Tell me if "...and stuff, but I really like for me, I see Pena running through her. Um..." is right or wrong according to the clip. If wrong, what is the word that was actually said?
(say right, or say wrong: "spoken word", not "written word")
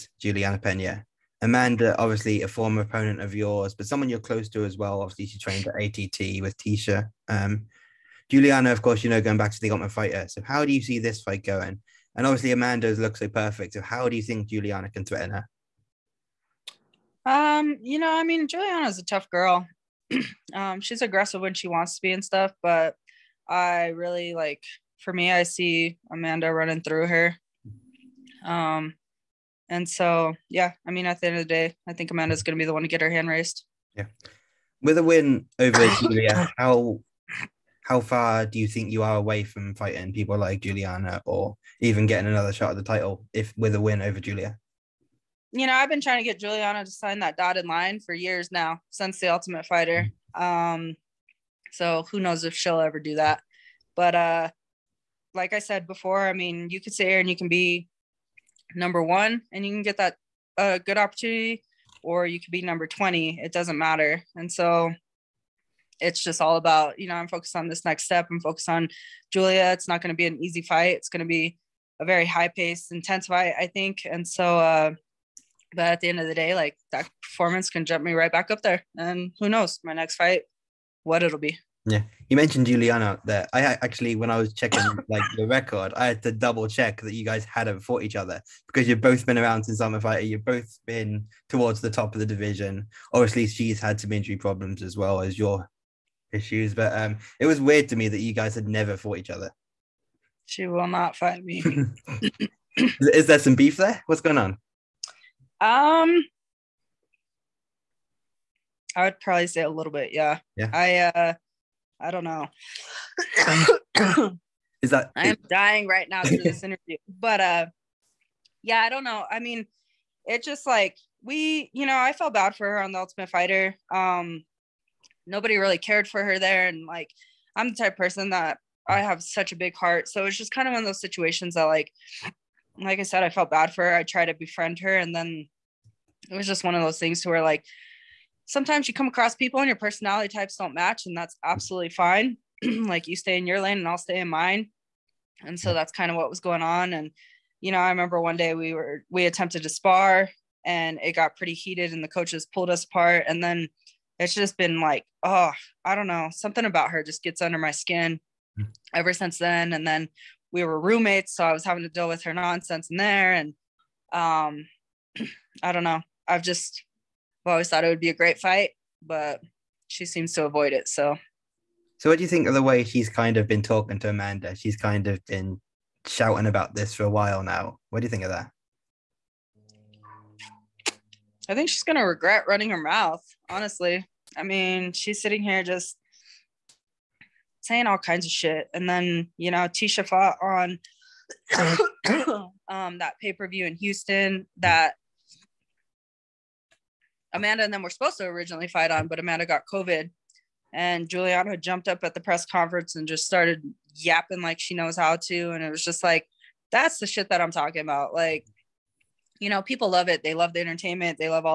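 wrong: "Amanda", not "Pena".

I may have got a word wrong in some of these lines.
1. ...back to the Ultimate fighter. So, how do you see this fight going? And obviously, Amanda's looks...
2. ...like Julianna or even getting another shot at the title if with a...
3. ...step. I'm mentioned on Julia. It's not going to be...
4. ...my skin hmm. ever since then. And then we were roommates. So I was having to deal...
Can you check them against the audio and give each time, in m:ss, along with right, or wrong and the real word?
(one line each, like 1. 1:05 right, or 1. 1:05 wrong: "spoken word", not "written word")
1. 0:09 right
2. 0:40 right
3. 1:08 wrong: "focused", not "mentioned"
4. 2:37 right.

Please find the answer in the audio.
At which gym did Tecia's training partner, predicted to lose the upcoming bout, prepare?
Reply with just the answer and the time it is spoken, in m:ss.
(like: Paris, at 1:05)
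ATT, at 0:05.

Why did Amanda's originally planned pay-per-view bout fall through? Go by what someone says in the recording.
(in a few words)
COVID.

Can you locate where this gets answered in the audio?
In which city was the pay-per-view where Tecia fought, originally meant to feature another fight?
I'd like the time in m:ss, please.
3:13.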